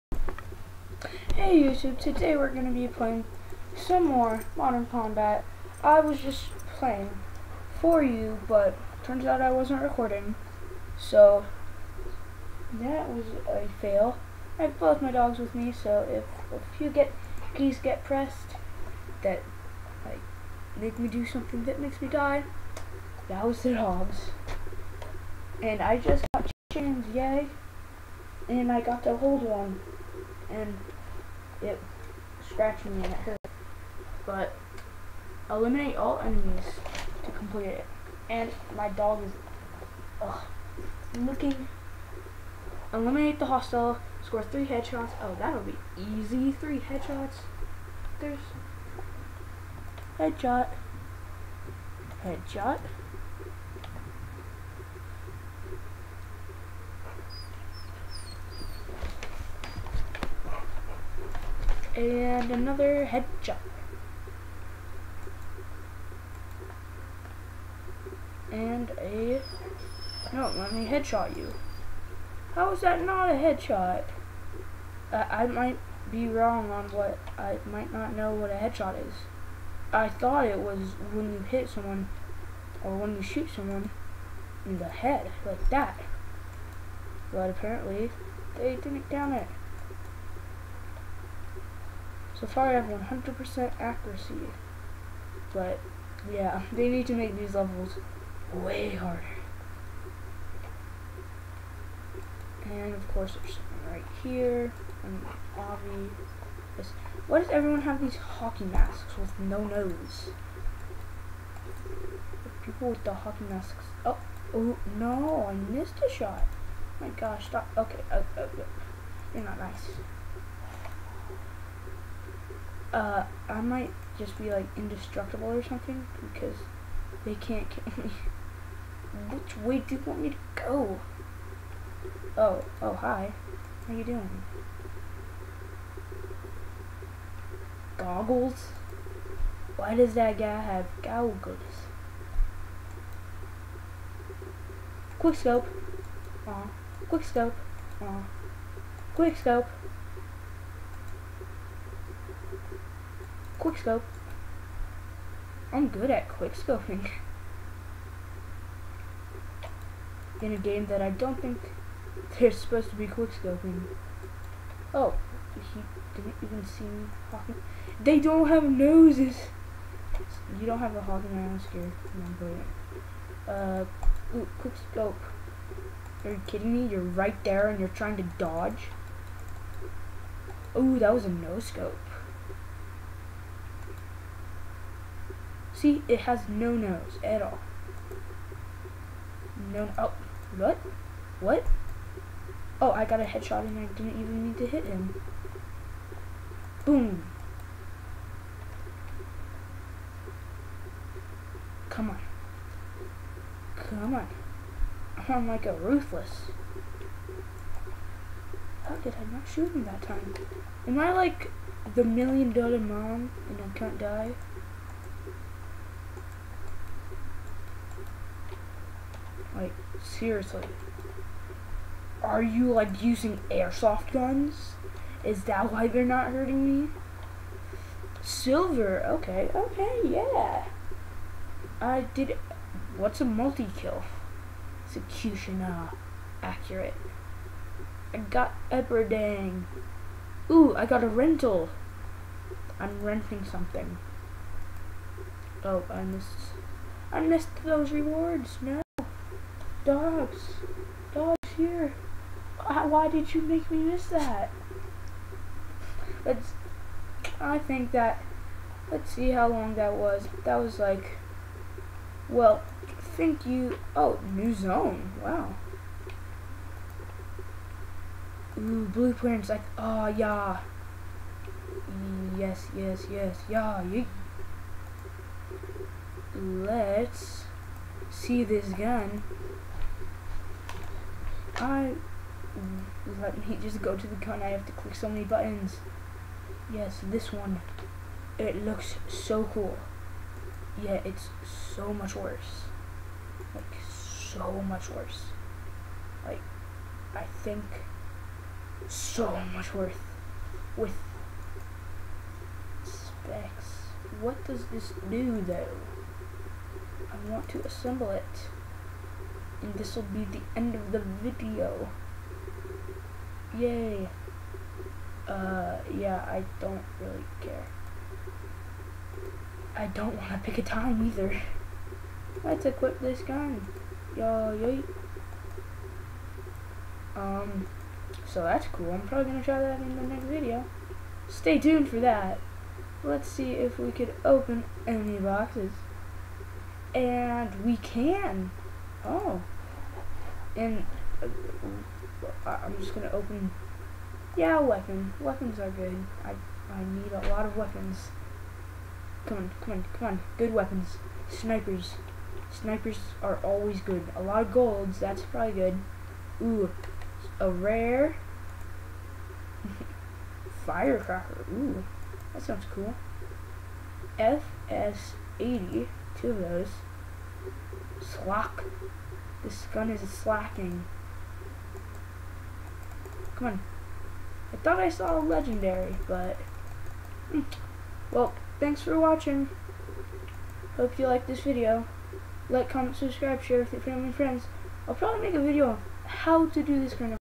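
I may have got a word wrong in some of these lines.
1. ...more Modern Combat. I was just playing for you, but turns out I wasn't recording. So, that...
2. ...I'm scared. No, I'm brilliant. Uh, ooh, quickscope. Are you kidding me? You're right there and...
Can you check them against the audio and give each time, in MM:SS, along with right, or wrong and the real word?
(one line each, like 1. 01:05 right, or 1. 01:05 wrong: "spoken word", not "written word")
1. 00:04 right
2. 02:51 right.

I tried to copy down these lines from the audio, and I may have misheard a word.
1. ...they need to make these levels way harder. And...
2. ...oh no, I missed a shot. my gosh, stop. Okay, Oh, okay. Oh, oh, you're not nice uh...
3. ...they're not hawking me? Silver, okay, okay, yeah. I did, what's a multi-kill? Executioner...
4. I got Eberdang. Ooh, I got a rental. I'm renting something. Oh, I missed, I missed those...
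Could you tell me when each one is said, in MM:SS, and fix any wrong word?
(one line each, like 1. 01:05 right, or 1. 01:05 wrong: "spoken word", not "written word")
1. 01:36 right
2. 01:54 right
3. 03:45 wrong: "hurting", not "hawking"
4. 03:58 right.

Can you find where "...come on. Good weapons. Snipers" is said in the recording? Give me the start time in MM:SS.
05:49.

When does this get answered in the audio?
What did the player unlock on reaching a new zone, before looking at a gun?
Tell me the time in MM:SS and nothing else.
04:28.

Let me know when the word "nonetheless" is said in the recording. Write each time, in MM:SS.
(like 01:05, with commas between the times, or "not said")
not said.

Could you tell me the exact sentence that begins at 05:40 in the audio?
And uh, uh, I'm just gonna open.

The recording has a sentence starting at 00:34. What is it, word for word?
But eliminate all enemies to complete it.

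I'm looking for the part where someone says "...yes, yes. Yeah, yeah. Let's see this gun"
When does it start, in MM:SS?
04:32.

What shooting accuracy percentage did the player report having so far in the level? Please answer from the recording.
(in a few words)
100%.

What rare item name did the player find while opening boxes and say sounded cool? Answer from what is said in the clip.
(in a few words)
Firecracker.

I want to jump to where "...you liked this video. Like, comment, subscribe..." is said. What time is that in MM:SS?
06:20.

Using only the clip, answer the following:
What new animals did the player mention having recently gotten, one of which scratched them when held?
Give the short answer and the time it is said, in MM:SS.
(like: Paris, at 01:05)
Chickens, at 00:26.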